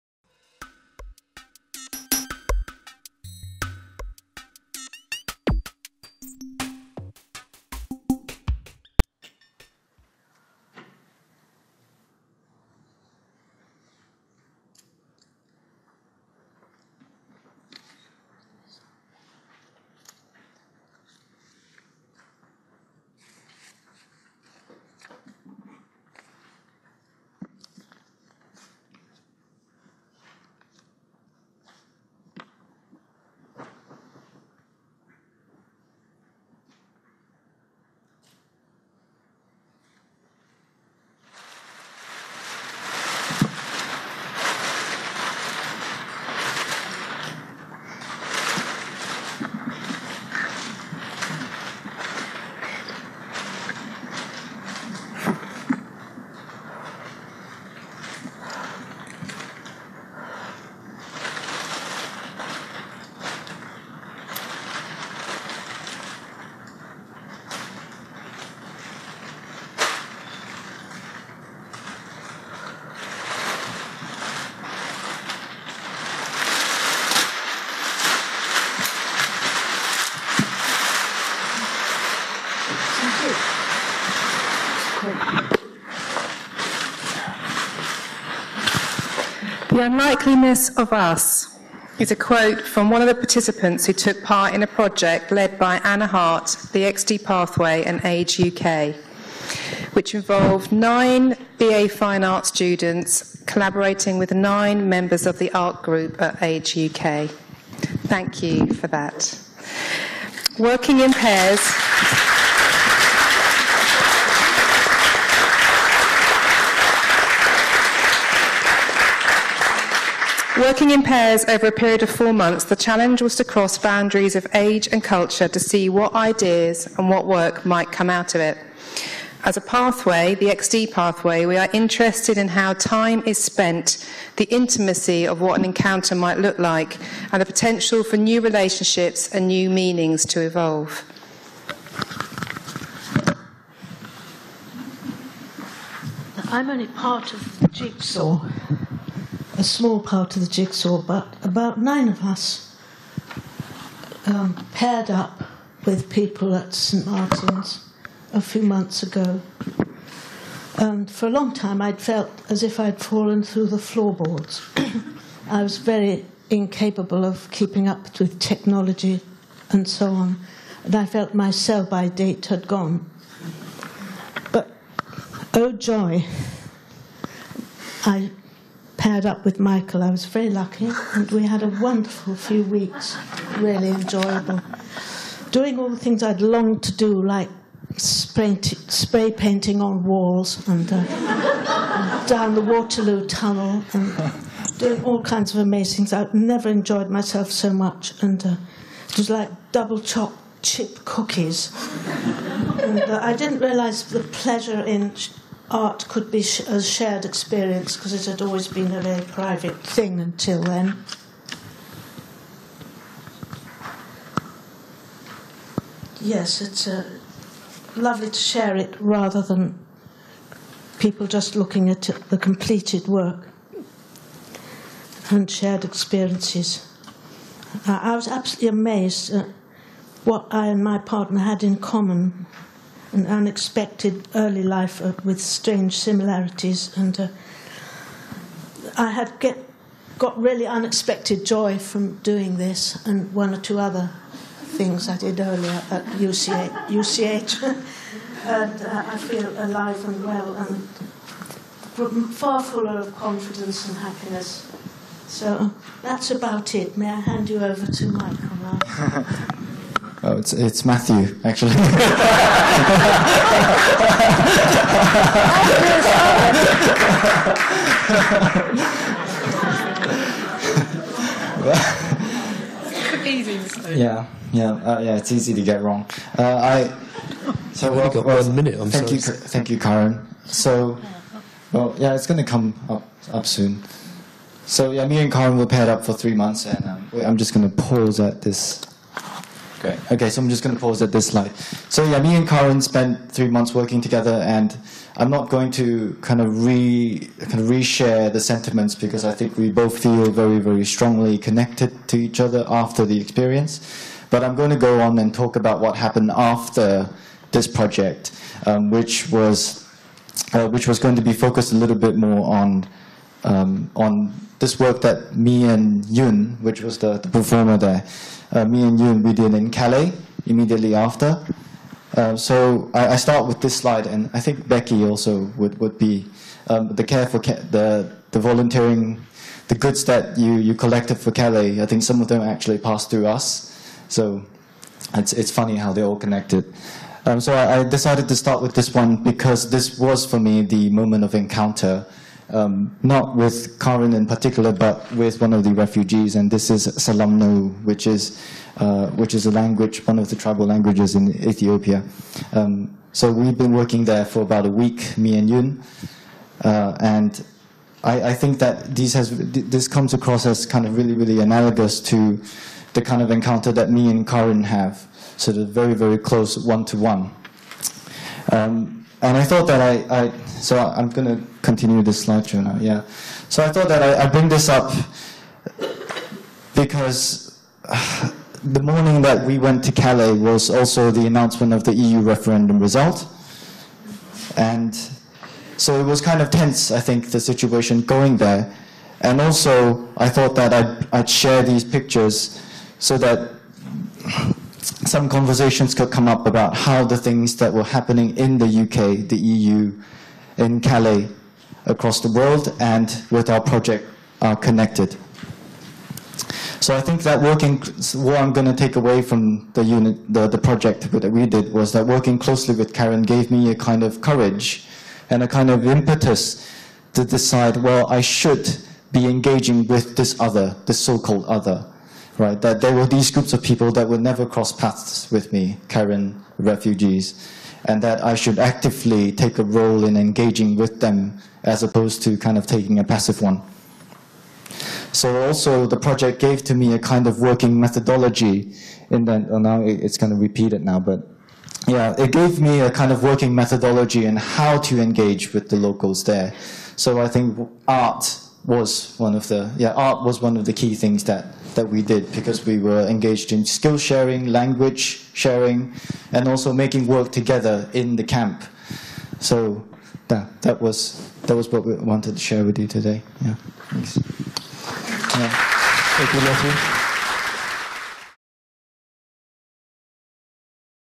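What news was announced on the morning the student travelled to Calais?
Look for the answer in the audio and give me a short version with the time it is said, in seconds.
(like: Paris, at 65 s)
EU referendum result, at 381 s.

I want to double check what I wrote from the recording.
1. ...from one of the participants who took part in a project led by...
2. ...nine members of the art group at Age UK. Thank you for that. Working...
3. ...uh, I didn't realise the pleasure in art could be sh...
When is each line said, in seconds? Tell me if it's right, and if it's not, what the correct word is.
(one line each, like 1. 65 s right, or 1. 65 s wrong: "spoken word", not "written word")
1. 92 s right
2. 104 s right
3. 203 s right.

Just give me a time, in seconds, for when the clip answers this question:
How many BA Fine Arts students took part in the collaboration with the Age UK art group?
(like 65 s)
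100 s.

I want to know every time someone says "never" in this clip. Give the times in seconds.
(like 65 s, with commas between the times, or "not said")
196 s, 424 s.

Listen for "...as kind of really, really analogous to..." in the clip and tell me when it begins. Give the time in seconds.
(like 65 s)
360 s.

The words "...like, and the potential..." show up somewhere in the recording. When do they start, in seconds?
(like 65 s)
136 s.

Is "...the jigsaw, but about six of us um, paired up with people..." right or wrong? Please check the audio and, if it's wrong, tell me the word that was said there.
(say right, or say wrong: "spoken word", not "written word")
wrong: "nine", not "six".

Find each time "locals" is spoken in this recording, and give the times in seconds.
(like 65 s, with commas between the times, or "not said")
445 s.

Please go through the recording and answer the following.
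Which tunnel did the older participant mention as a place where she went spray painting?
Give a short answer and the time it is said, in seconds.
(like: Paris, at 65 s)
Waterloo Tunnel, at 192 s.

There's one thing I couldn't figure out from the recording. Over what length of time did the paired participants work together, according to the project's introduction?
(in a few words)
4 months.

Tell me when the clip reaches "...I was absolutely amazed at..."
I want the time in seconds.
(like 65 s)
228 s.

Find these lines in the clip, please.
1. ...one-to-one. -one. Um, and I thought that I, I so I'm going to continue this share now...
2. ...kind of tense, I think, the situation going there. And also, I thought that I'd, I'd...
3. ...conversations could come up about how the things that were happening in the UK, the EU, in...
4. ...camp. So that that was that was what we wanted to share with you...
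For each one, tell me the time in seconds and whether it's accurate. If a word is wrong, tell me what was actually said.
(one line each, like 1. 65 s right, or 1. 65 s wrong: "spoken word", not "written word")
1. 366 s wrong: "lecture", not "share"
2. 386 s right
3. 395 s right
4. 458 s right.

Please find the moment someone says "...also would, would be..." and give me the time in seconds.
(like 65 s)
325 s.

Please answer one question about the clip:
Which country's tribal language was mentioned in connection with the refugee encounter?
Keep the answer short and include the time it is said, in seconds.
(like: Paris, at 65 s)
Ethiopia, at 351 s.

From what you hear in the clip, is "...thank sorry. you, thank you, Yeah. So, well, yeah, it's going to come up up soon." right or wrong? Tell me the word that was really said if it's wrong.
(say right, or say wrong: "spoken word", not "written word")
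wrong: "Karen", not "Yeah".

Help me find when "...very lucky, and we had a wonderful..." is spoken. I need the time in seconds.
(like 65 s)
180 s.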